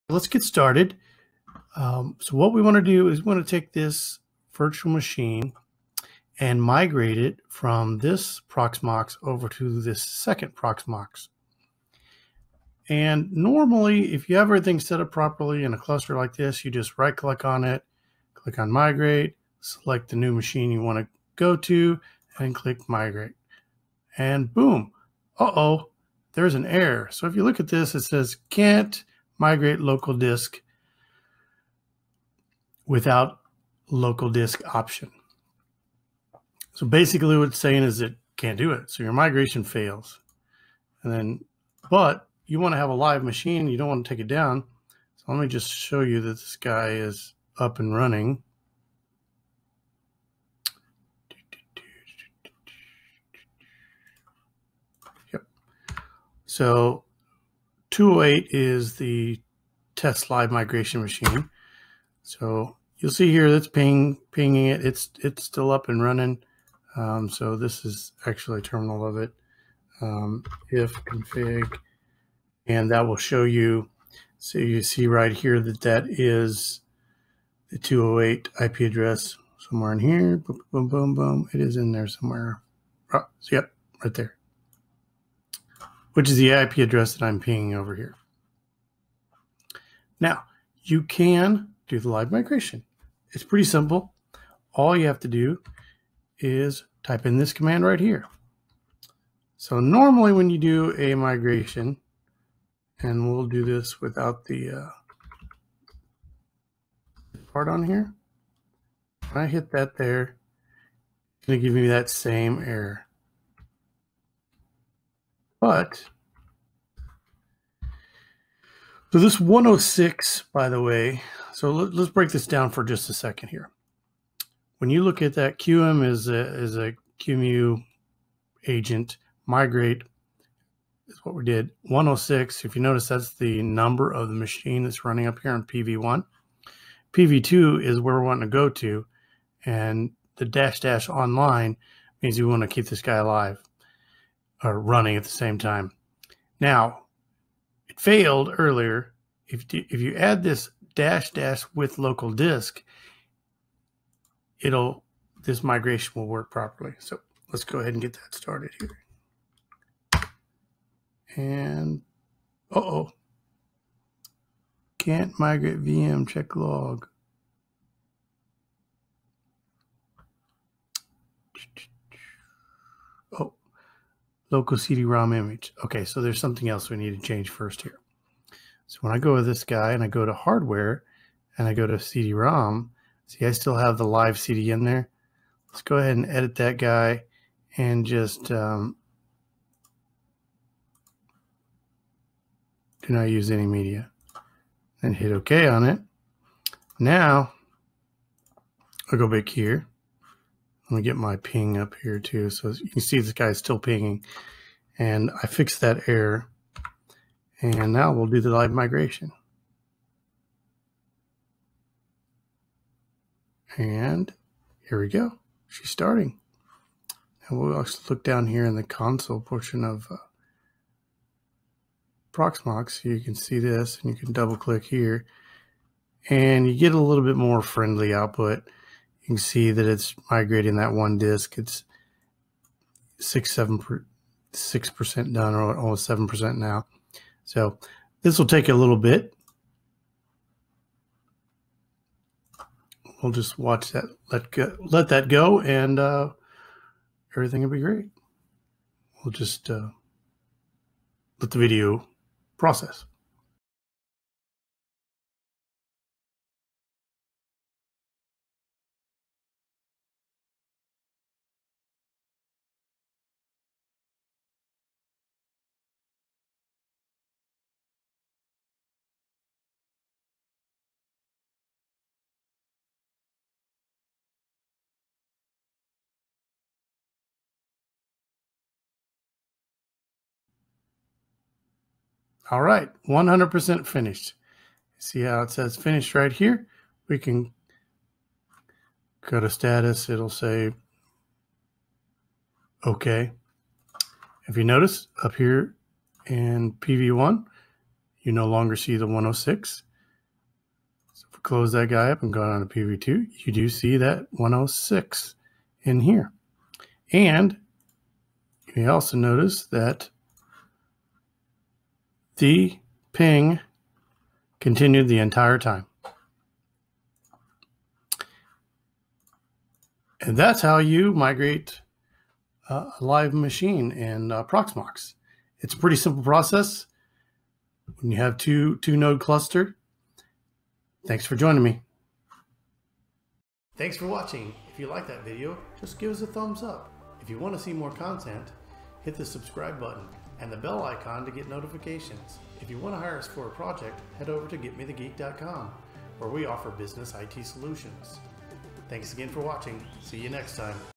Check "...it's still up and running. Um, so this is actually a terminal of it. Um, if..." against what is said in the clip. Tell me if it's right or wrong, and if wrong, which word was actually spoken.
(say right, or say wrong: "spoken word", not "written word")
right.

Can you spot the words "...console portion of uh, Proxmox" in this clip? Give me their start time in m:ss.
3:38.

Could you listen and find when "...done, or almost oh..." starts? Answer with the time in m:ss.
3:55.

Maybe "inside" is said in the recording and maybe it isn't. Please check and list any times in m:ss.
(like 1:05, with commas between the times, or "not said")
not said.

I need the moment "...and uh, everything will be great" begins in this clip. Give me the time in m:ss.
4:05.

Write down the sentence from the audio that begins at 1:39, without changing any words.
So normally when you do a migration, and we'll do this without the uh, part on here.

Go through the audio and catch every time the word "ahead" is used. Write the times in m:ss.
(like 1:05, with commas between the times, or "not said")
2:37, 3:05.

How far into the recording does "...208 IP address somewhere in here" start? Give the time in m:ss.
1:17.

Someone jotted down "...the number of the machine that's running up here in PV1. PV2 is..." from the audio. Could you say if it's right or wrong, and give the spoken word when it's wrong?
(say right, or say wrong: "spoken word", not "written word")
right.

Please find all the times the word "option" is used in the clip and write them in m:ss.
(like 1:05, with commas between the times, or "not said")
0:34.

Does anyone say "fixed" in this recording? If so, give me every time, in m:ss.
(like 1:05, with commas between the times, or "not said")
3:25.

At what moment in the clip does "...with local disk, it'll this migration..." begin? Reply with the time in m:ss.
2:31.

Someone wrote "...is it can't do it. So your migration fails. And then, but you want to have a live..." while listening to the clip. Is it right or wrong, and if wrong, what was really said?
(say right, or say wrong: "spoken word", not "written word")
right.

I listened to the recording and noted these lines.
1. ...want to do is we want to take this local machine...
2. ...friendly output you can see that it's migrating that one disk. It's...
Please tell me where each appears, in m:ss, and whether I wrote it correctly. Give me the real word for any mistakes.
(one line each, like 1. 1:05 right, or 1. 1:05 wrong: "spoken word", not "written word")
1. 0:02 wrong: "virtual", not "local"
2. 3:47 right.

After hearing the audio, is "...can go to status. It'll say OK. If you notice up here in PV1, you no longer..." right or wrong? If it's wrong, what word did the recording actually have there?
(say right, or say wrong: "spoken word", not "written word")
right.